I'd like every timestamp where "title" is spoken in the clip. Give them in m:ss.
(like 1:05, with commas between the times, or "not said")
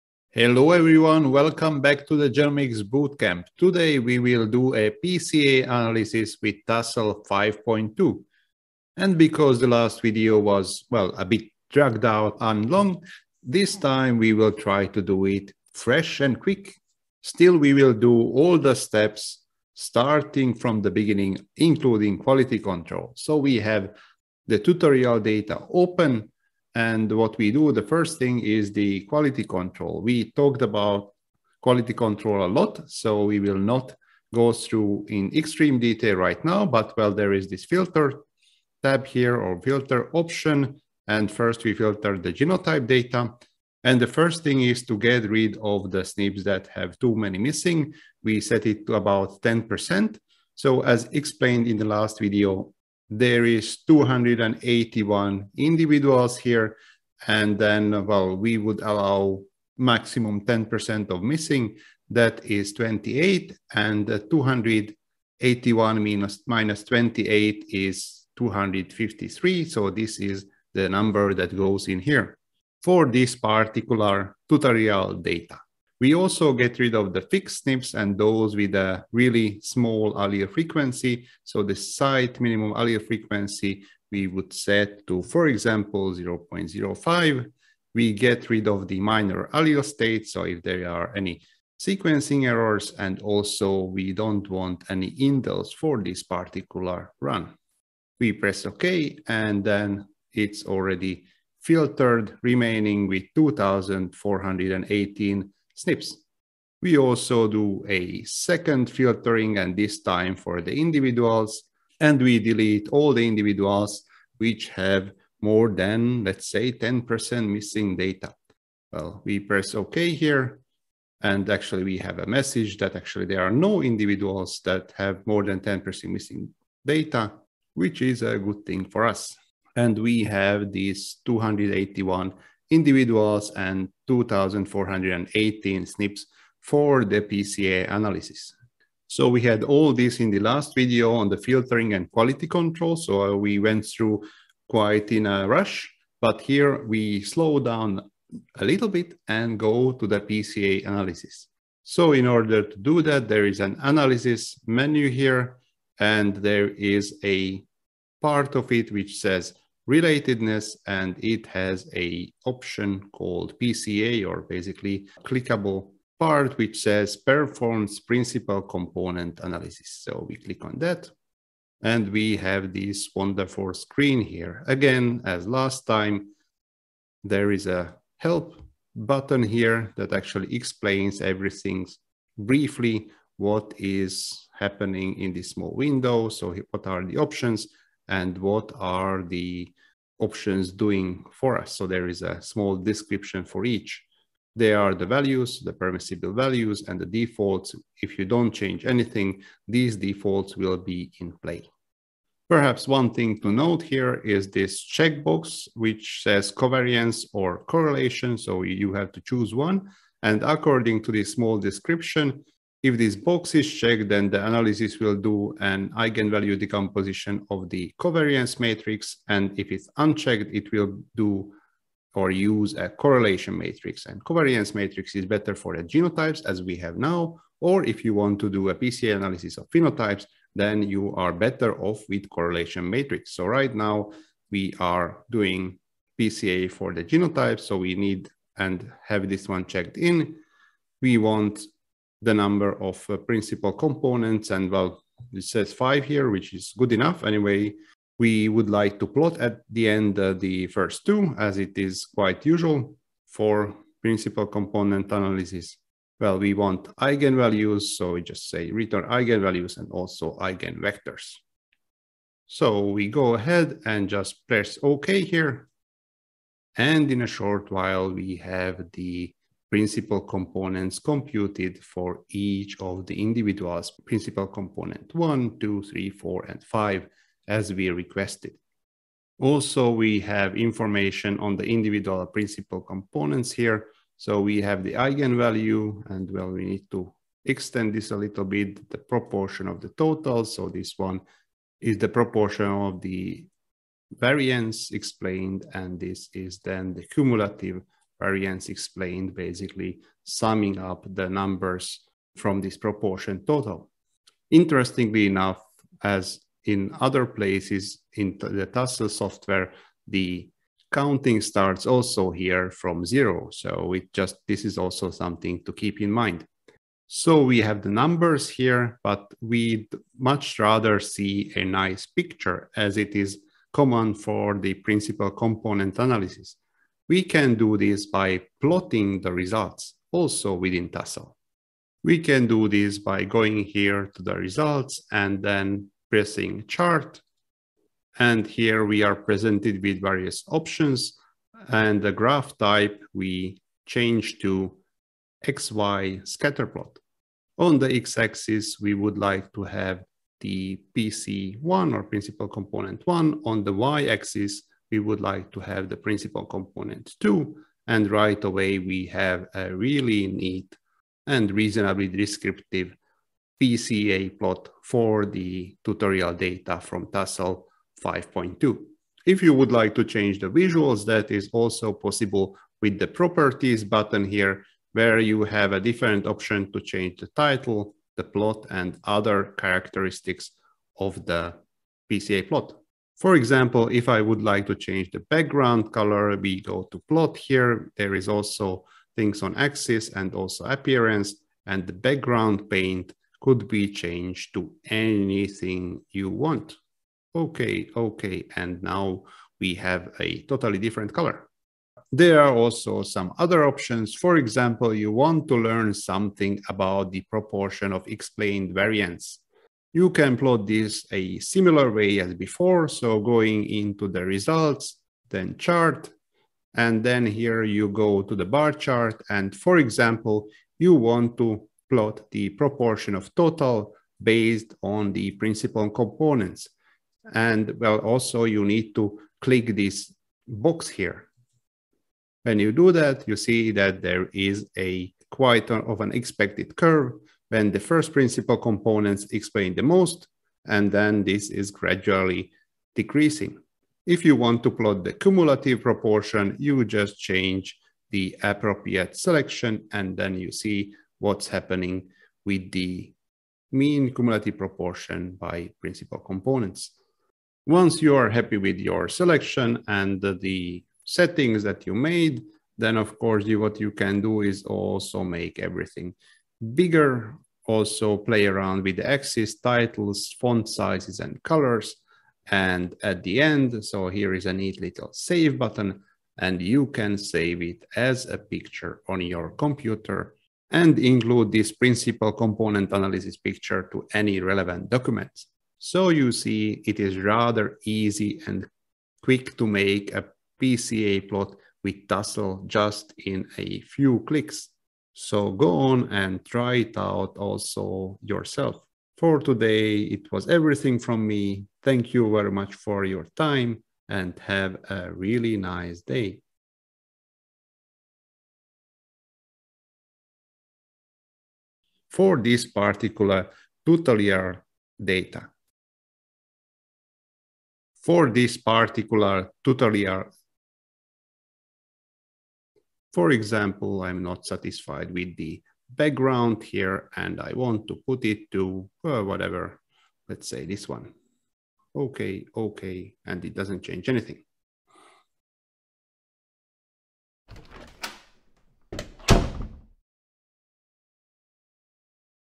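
6:17, 7:49.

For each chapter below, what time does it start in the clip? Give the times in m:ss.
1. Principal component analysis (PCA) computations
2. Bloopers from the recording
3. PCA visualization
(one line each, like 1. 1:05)
1. 2:31
2. 8:27
3. 5:26.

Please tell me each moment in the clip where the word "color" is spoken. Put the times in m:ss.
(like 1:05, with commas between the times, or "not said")
6:25, 6:41, 7:51.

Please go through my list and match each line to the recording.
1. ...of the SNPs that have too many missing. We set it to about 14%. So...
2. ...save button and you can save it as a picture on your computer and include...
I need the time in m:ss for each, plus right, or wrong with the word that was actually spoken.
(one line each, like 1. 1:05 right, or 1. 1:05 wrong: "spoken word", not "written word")
1. 0:45 wrong: "10", not "14"
2. 7:55 right.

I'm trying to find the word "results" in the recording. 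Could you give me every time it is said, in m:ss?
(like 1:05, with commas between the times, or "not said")
5:29, 5:34, 6:54.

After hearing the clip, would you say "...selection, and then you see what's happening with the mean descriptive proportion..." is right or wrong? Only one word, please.
wrong.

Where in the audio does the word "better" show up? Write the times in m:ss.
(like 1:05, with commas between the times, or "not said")
3:45, 3:51.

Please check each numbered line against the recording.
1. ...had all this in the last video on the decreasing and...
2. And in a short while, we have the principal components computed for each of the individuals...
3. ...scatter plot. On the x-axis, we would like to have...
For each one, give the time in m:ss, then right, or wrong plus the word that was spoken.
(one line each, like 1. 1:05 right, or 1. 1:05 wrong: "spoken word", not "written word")
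1. 2:19 wrong: "filtering", not "decreasing"
2. 4:26 right
3. 5:46 right.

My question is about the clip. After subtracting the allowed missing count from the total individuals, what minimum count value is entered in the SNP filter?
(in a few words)
253.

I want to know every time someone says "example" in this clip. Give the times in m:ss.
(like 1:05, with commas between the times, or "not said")
1:25, 6:23, 6:44, 6:59, 8:43.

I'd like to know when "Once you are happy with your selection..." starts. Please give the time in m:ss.
7:37.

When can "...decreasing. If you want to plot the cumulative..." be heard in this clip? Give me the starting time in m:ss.
7:22.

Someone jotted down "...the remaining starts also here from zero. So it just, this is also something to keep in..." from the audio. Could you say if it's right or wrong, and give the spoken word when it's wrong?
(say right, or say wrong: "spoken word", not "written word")
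wrong: "counting", not "remaining".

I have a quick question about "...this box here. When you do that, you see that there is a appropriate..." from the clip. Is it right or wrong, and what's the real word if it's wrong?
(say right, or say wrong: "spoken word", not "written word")
wrong: "quite", not "appropriate".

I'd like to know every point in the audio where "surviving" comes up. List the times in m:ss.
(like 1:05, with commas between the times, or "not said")
not said.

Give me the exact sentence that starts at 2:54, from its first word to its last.
Again, as last time, there is a help button here that actually explains everything briefly, what is happening in this small window.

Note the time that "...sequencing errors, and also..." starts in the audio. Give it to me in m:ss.
1:31.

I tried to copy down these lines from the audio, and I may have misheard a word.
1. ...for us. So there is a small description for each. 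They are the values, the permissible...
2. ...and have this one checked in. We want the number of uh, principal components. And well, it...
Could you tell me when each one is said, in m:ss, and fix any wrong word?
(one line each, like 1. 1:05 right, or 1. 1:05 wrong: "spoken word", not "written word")
1. 3:11 right
2. 3:58 right.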